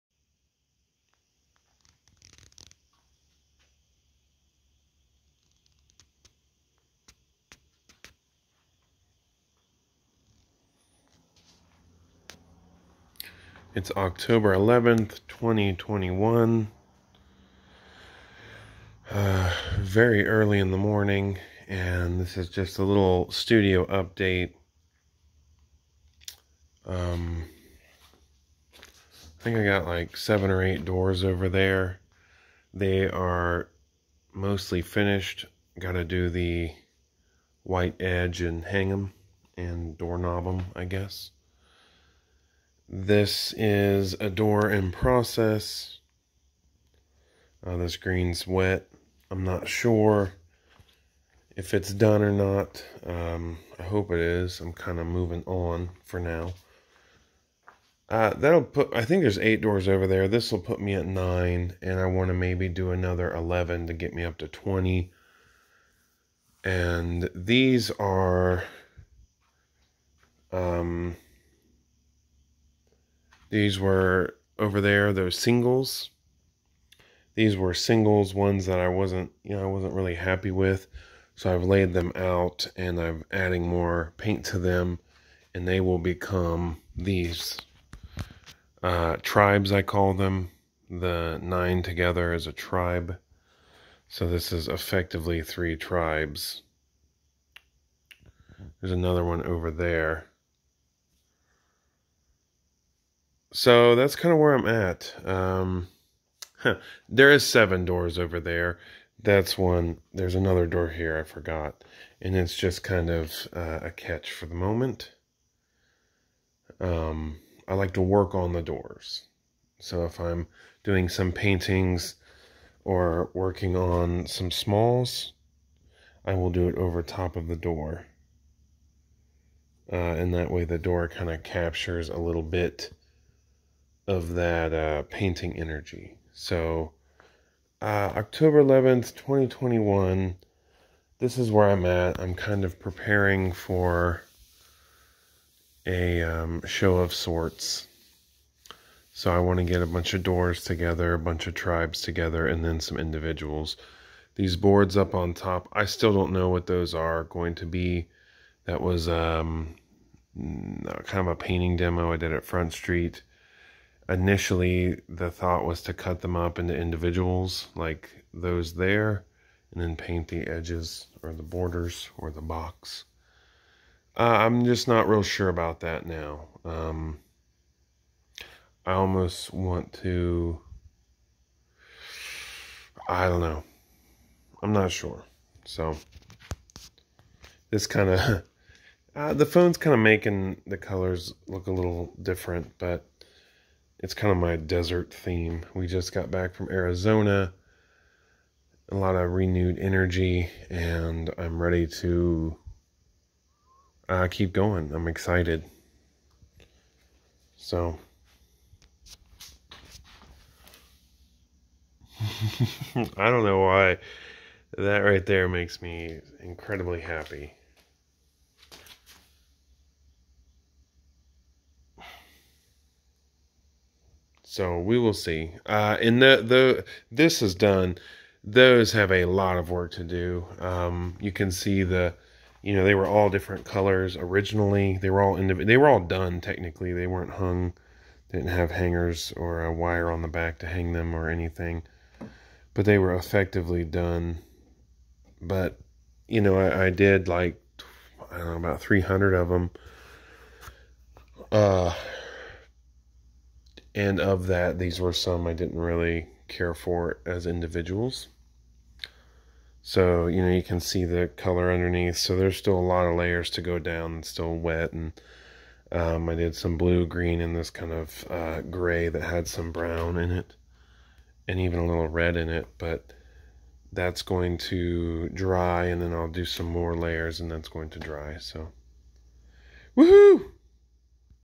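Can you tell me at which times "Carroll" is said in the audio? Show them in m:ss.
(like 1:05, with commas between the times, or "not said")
not said.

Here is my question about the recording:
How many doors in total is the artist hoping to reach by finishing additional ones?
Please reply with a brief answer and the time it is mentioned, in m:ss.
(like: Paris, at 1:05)
20, at 1:04.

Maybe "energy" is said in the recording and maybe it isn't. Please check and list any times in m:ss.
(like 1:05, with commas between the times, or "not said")
2:15, 3:19.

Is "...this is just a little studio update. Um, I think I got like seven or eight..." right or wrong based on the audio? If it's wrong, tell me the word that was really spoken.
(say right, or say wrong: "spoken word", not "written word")
right.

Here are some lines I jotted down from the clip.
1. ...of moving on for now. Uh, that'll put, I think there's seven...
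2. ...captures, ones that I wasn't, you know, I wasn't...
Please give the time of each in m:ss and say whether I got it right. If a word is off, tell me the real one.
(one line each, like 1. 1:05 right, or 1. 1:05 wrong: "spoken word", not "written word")
1. 0:54 wrong: "eight", not "seven"
2. 1:17 wrong: "singles", not "captures".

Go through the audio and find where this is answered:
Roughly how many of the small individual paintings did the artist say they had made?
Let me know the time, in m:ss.
4:08.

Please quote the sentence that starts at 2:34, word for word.
These boards up on top, I still don't know what those are going to be.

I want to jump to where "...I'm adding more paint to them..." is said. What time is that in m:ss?
1:22.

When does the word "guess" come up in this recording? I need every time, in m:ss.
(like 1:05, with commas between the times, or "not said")
0:40.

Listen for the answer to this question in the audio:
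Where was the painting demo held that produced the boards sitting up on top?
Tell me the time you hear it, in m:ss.
2:42.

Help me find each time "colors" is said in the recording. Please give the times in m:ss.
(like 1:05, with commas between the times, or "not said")
3:10, 3:53, 4:21.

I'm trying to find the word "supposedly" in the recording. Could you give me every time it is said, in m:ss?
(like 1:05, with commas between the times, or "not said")
not said.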